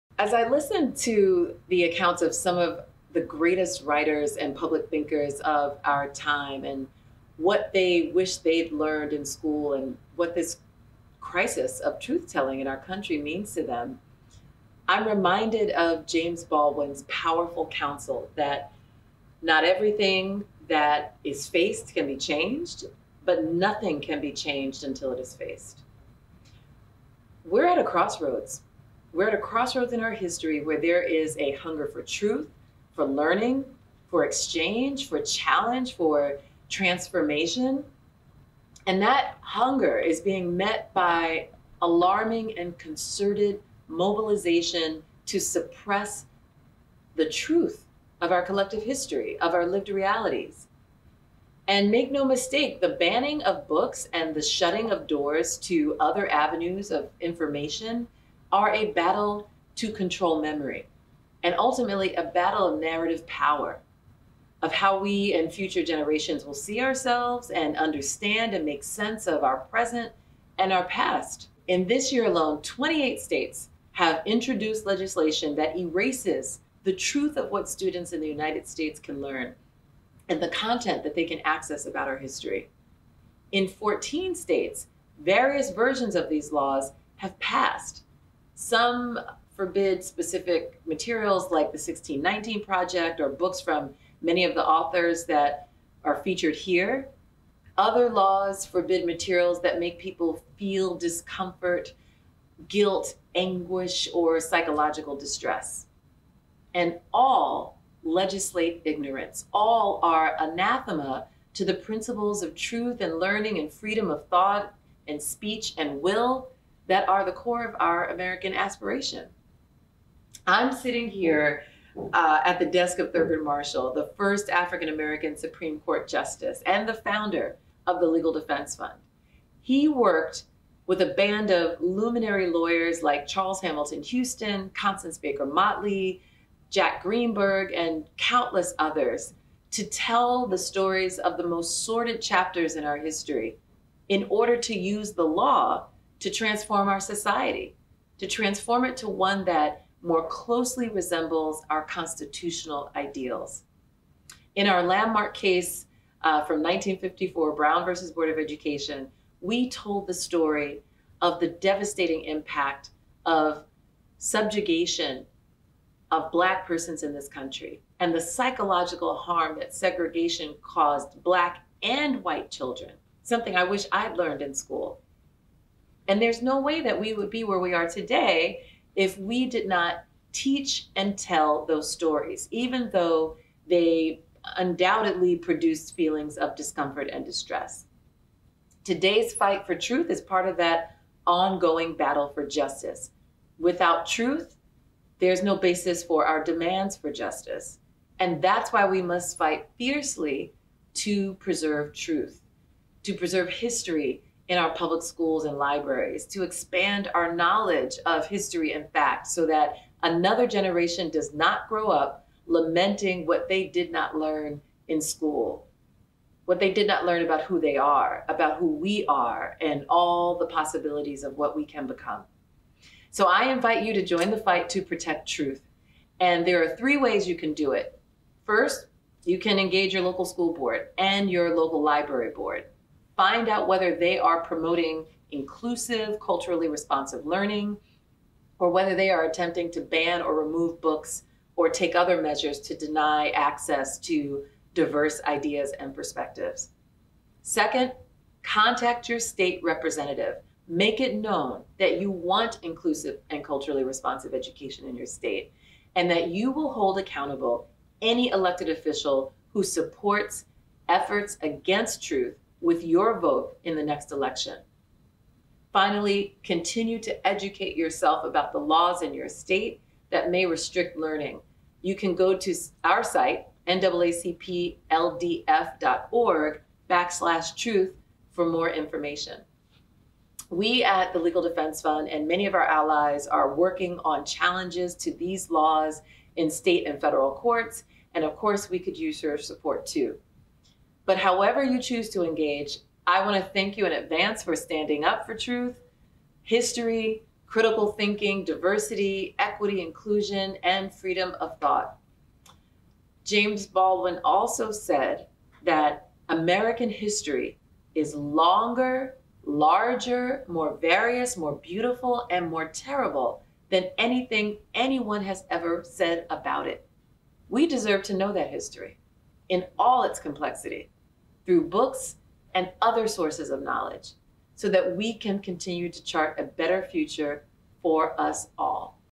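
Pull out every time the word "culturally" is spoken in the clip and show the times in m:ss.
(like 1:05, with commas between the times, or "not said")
3:56, 4:13.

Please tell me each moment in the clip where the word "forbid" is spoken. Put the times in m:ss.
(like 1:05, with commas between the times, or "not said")
1:29, 1:38.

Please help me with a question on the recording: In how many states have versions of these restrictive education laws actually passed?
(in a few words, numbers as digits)
14.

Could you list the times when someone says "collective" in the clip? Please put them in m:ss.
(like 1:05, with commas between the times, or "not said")
0:48.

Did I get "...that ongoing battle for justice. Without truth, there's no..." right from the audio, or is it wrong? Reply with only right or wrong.
right.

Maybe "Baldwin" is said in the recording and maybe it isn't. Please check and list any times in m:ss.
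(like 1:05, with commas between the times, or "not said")
0:16, 5:03.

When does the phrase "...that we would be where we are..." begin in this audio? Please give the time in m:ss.
2:56.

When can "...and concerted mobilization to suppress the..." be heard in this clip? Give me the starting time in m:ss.
0:42.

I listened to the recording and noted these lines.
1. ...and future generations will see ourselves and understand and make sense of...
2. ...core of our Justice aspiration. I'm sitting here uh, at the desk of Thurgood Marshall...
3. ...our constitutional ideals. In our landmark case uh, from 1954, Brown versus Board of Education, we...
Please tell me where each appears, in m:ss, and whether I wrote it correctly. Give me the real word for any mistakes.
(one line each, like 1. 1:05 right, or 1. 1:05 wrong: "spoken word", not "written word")
1. 1:05 right
2. 1:57 wrong: "American", not "Justice"
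3. 2:31 right.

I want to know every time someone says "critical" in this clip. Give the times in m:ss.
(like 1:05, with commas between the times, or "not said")
4:57.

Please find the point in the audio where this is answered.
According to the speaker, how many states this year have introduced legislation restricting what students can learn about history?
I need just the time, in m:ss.
1:12.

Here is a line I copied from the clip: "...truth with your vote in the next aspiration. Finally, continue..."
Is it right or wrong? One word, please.
wrong.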